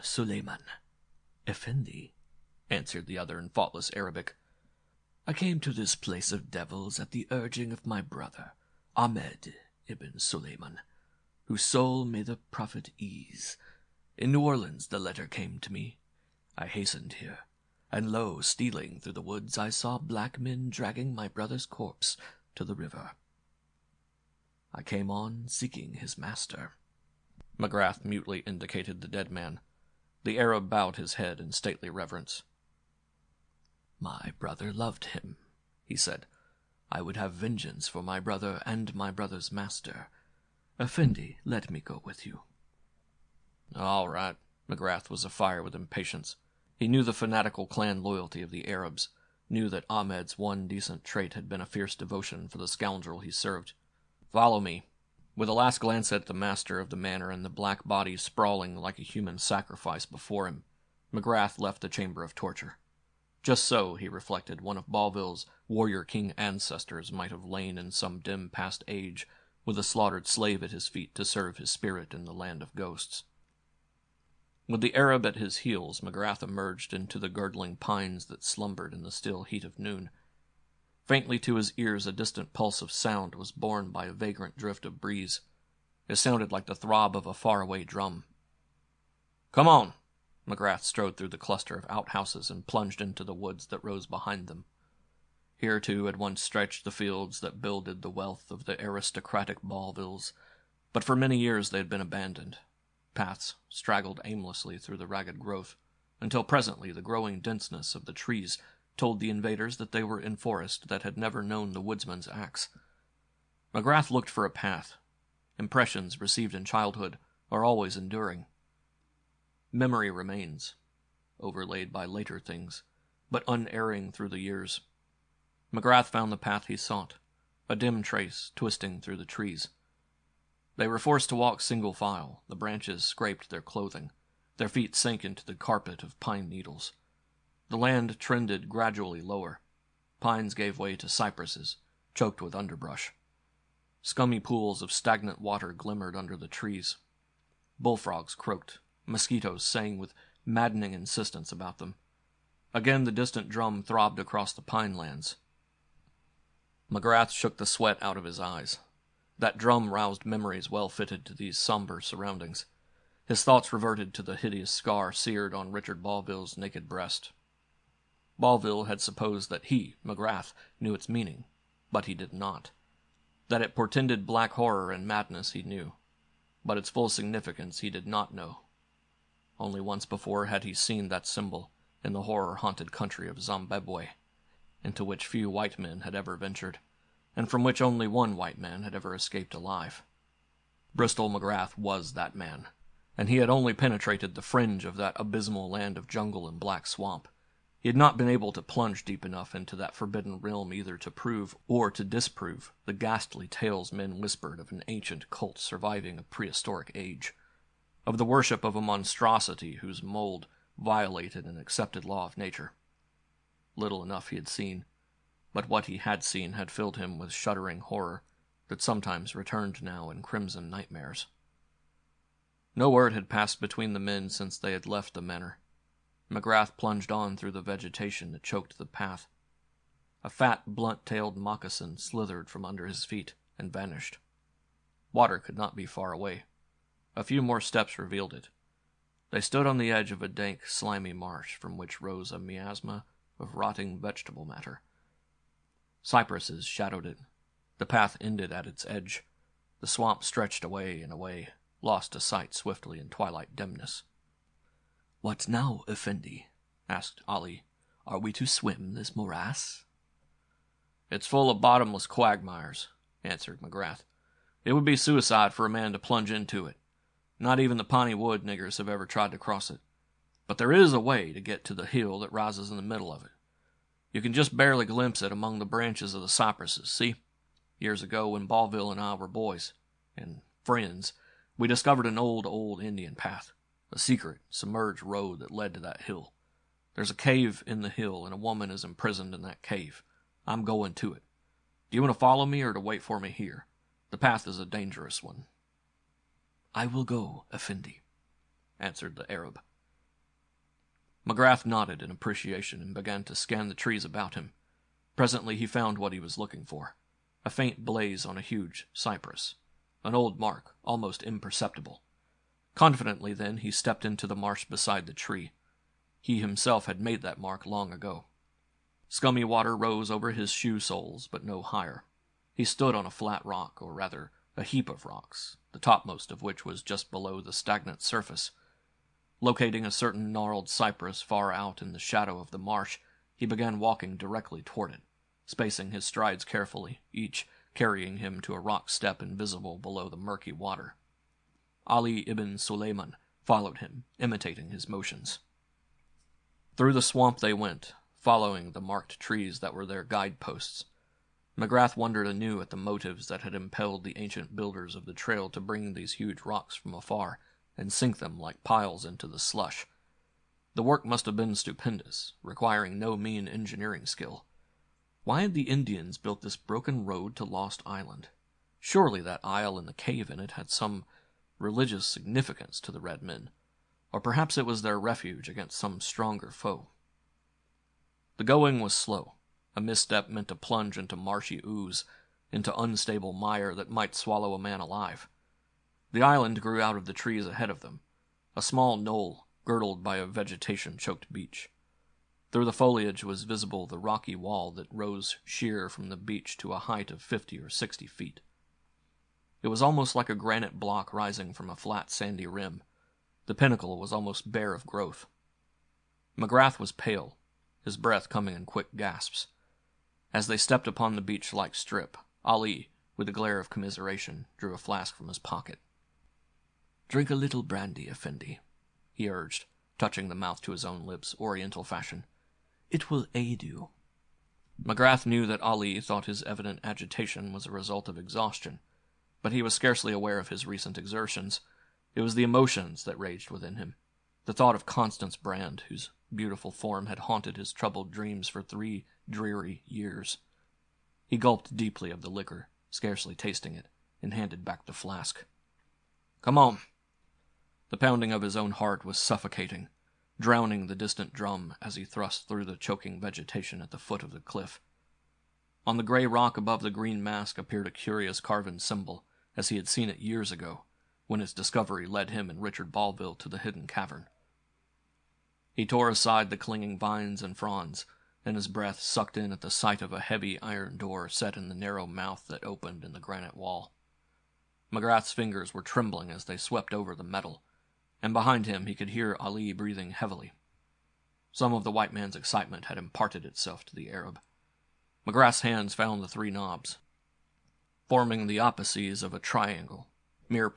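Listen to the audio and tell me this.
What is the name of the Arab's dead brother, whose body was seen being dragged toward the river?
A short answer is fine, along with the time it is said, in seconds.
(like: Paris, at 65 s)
Ahmed ibn Suleiman, at 8 s.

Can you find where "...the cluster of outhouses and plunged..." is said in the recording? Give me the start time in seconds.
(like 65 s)
91 s.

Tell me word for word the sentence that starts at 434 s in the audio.
The thought of Constance Brand, whose beautiful form had haunted his troubled dreams for three dreary years.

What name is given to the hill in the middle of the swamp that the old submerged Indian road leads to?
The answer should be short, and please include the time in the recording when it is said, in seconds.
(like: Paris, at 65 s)
Lost Island, at 367 s.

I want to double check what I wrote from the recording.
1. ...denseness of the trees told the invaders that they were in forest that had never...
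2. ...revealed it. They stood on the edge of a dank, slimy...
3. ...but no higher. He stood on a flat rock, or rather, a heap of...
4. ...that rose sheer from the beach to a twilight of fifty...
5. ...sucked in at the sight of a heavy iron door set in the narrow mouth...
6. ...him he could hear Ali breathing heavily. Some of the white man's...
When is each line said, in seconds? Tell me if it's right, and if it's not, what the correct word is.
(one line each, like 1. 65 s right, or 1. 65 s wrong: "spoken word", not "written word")
1. 107 s right
2. 237 s right
3. 321 s right
4. 394 s wrong: "height", not "twilight"
5. 468 s right
6. 478 s right.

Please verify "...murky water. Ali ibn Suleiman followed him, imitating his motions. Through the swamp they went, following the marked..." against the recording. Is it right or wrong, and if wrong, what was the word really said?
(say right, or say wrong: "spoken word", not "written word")
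right.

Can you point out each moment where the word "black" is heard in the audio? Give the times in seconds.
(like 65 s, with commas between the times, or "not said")
19 s, 57 s, 174 s, 196 s.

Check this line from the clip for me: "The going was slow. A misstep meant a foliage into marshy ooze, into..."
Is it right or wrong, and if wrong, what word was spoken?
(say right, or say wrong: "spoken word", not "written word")
wrong: "plunge", not "foliage".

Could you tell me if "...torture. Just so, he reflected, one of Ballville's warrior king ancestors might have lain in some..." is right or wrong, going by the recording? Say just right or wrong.
right.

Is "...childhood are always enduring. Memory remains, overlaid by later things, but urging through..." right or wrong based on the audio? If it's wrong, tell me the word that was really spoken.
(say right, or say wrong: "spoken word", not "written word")
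wrong: "unerring", not "urging".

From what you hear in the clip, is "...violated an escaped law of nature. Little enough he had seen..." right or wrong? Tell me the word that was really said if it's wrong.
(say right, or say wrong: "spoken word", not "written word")
wrong: "accepted", not "escaped".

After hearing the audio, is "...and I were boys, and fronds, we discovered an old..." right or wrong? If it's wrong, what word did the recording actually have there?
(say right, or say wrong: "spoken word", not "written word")
wrong: "friends", not "fronds".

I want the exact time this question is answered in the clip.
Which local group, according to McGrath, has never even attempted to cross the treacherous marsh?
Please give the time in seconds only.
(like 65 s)
267 s.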